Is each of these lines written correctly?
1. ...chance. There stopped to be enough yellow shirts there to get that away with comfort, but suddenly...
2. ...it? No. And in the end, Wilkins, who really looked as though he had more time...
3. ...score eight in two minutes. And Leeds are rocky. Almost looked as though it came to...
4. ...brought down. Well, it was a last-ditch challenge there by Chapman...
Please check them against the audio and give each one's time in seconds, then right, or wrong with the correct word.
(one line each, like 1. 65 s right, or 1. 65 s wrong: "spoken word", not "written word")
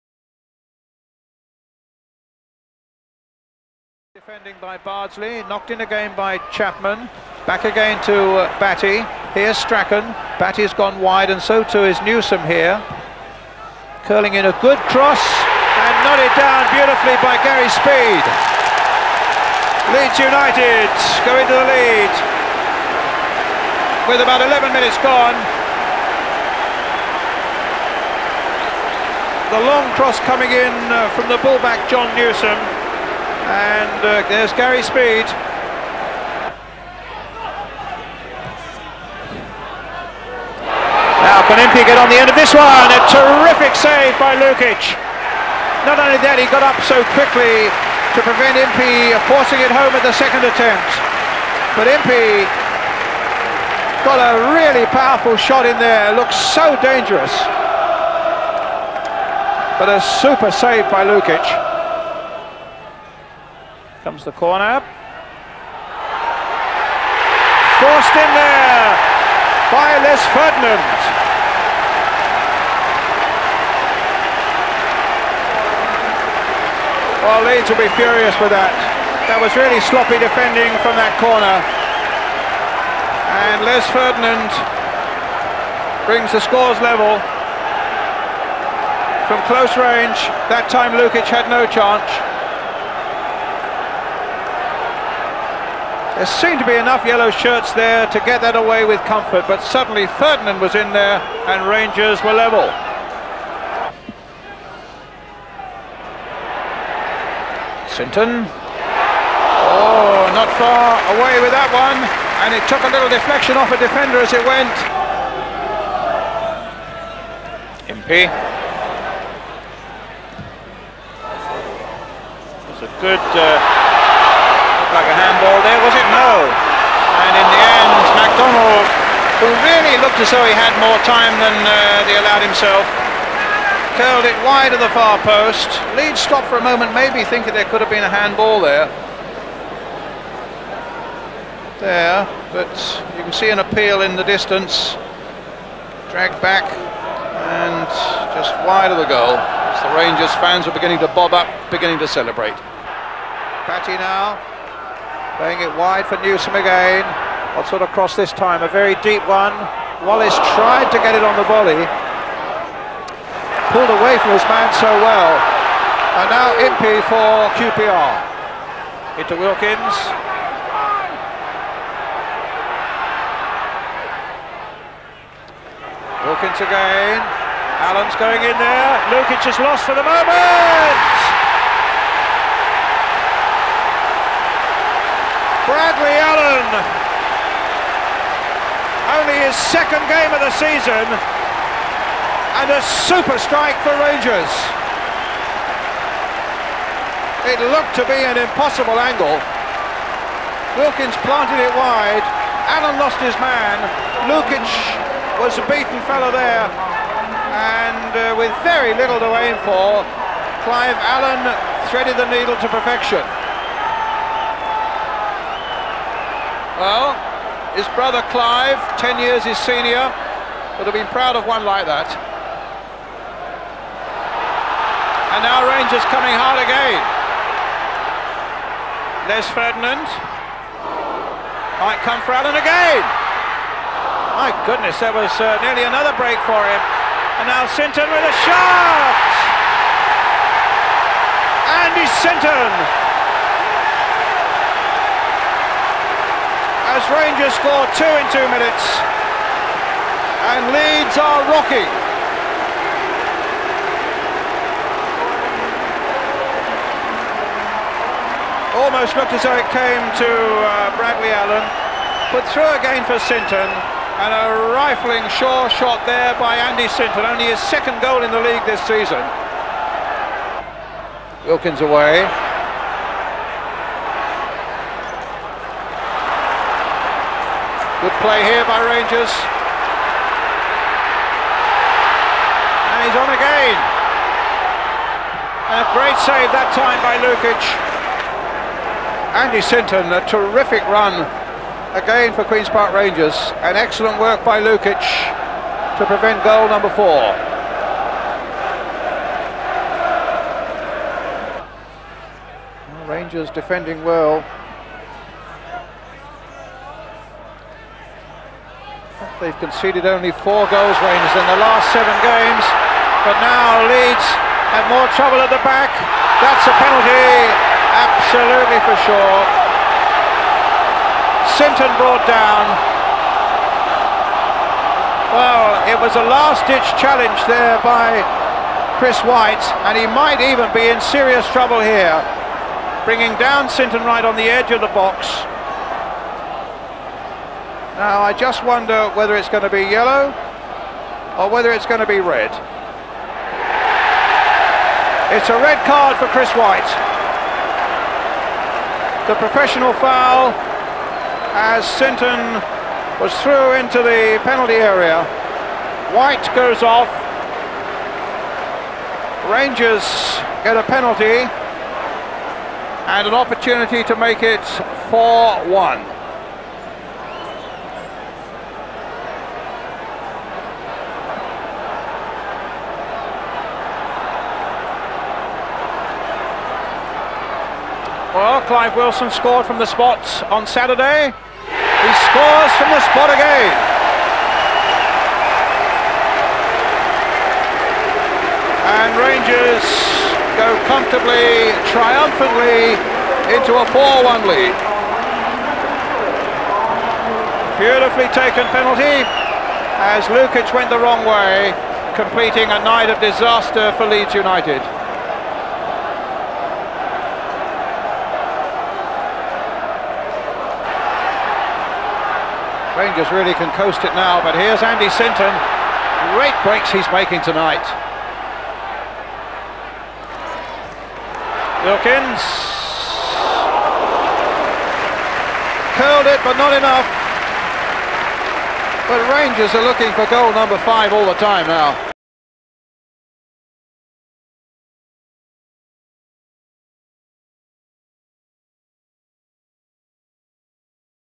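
1. 91 s wrong: "seemed", not "stopped"
2. 125 s wrong: "McDonald", not "Wilkins"
3. 247 s wrong: "two", not "eight"
4. 321 s wrong: "Chris", not "Chapman".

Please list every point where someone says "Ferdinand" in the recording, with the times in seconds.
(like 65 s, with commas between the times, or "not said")
70 s, 83 s, 100 s, 229 s.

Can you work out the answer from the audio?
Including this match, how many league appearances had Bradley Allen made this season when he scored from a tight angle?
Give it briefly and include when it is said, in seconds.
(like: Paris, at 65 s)
2, at 189 s.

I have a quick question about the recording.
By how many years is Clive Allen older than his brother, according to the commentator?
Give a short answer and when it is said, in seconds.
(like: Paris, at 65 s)
10, at 218 s.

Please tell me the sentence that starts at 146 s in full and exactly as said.
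Dragged back and just wide of the goal.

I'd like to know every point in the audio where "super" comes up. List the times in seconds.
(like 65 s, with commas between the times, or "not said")
60 s, 193 s.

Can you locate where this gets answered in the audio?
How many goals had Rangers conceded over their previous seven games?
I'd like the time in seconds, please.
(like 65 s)
310 s.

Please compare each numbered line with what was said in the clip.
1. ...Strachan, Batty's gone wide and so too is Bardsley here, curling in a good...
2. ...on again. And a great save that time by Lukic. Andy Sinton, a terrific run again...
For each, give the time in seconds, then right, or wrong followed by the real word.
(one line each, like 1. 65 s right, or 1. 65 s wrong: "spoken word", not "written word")
1. 9 s wrong: "Newsome", not "Bardsley"
2. 283 s right.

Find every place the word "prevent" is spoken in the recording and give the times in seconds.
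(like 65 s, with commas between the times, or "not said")
48 s, 296 s.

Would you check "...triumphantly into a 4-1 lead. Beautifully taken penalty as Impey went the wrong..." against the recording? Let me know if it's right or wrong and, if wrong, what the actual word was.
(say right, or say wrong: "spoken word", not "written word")
wrong: "Lukic", not "Impey".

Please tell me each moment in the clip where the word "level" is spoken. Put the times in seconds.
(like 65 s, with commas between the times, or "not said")
86 s, 102 s.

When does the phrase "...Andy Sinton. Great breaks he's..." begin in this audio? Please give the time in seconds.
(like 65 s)
414 s.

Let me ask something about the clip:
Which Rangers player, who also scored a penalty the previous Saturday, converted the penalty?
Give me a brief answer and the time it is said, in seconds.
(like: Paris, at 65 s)
Clive Wilson, at 378 s.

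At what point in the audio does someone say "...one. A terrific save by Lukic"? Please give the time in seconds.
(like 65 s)
42 s.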